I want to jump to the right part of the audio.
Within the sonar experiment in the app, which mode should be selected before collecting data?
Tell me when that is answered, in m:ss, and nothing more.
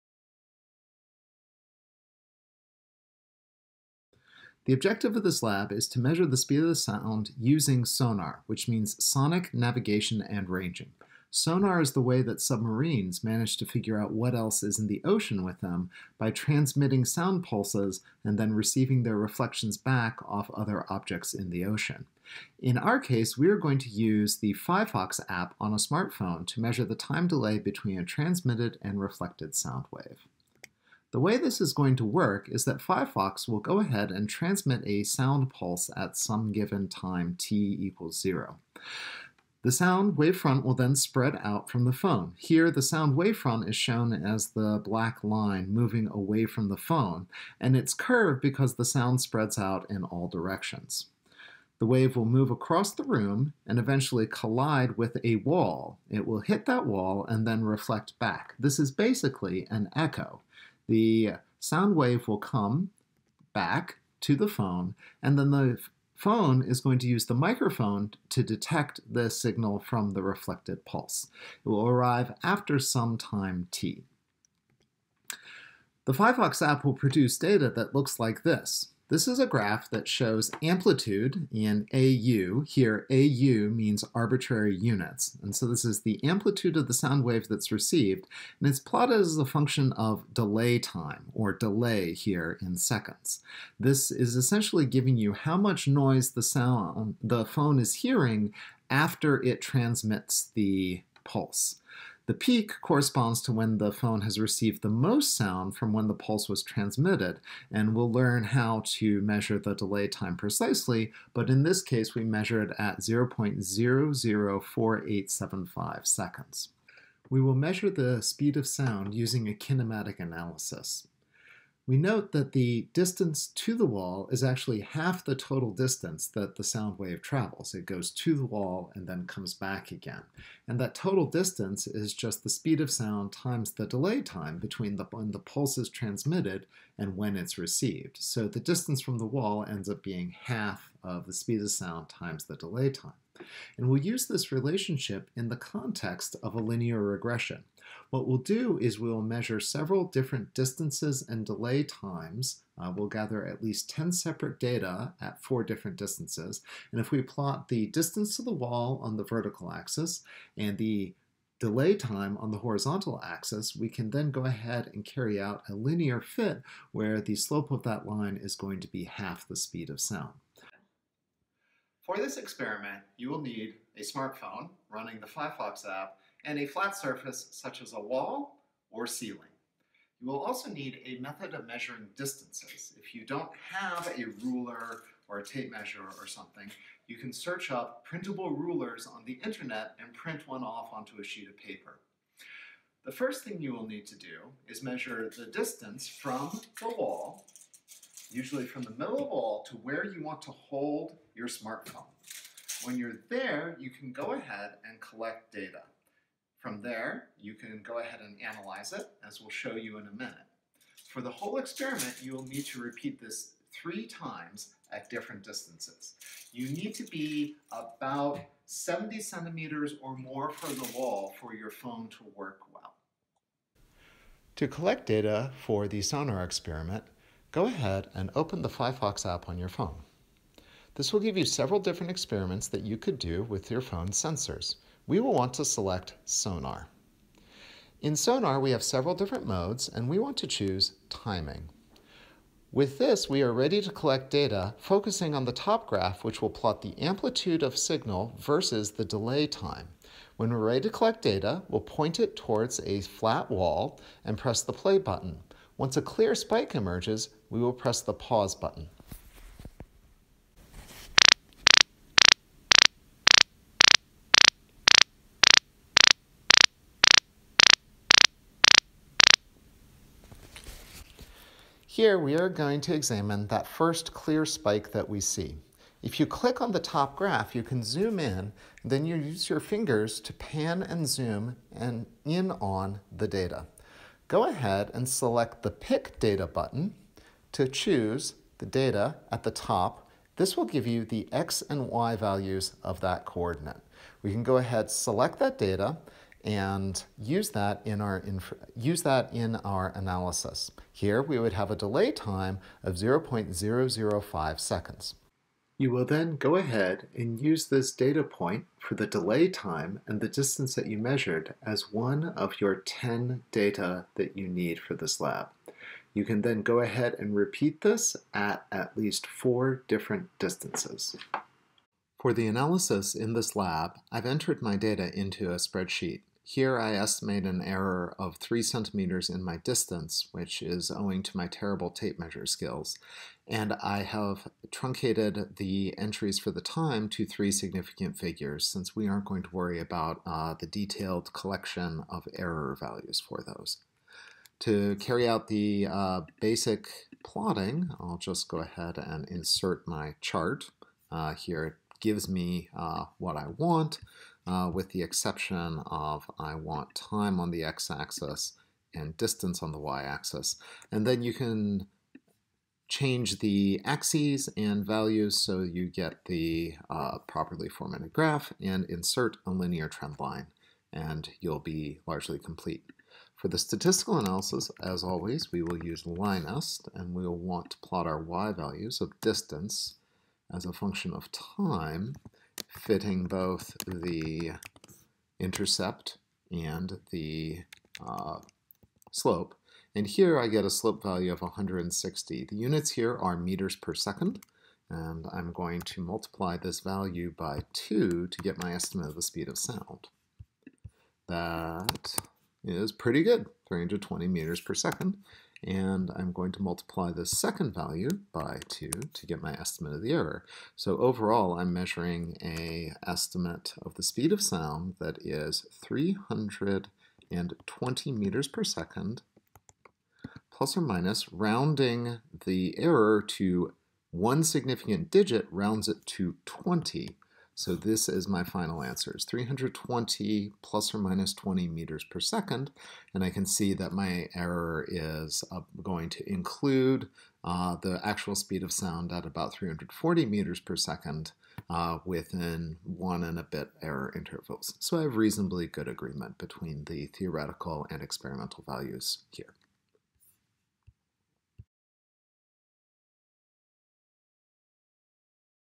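4:01.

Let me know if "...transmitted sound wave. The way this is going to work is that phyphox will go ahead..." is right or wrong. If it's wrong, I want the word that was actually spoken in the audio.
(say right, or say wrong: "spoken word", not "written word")
wrong: "reflected", not "transmitted".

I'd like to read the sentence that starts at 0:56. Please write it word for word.
It will hit that wall and then reflect back.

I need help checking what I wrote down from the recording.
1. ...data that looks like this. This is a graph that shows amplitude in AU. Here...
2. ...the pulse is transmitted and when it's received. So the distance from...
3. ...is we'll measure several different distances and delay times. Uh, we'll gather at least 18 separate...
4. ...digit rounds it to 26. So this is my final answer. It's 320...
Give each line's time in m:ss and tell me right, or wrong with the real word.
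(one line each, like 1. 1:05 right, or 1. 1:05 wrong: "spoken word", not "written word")
1. 1:17 right
2. 2:15 right
3. 2:28 wrong: "10", not "18"
4. 7:05 wrong: "20", not "26".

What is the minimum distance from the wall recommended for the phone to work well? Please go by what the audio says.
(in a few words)
70 centimeters.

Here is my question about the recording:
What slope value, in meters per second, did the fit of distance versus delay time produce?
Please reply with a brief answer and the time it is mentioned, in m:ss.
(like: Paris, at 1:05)
160, at 6:31.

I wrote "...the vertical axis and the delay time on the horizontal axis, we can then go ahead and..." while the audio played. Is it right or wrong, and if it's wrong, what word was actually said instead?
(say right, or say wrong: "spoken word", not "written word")
right.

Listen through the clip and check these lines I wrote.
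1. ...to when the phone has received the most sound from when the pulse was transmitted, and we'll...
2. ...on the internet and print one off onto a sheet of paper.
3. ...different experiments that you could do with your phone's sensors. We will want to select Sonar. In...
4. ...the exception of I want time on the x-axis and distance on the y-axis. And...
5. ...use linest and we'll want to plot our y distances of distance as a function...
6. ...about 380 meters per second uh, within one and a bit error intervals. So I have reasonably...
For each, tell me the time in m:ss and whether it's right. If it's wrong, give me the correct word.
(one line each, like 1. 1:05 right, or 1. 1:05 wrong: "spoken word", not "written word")
1. 1:43 right
2. 3:09 right
3. 3:51 right
4. 5:54 right
5. 6:15 wrong: "values", not "distances"
6. 7:19 wrong: "340", not "380".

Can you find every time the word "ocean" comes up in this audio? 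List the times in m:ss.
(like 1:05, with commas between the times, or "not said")
0:15, 0:21.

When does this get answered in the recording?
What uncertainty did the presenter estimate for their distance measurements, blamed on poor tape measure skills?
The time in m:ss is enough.
5:28.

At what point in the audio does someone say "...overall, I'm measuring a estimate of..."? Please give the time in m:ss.
6:50.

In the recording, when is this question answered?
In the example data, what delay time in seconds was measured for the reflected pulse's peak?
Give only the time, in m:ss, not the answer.
1:52.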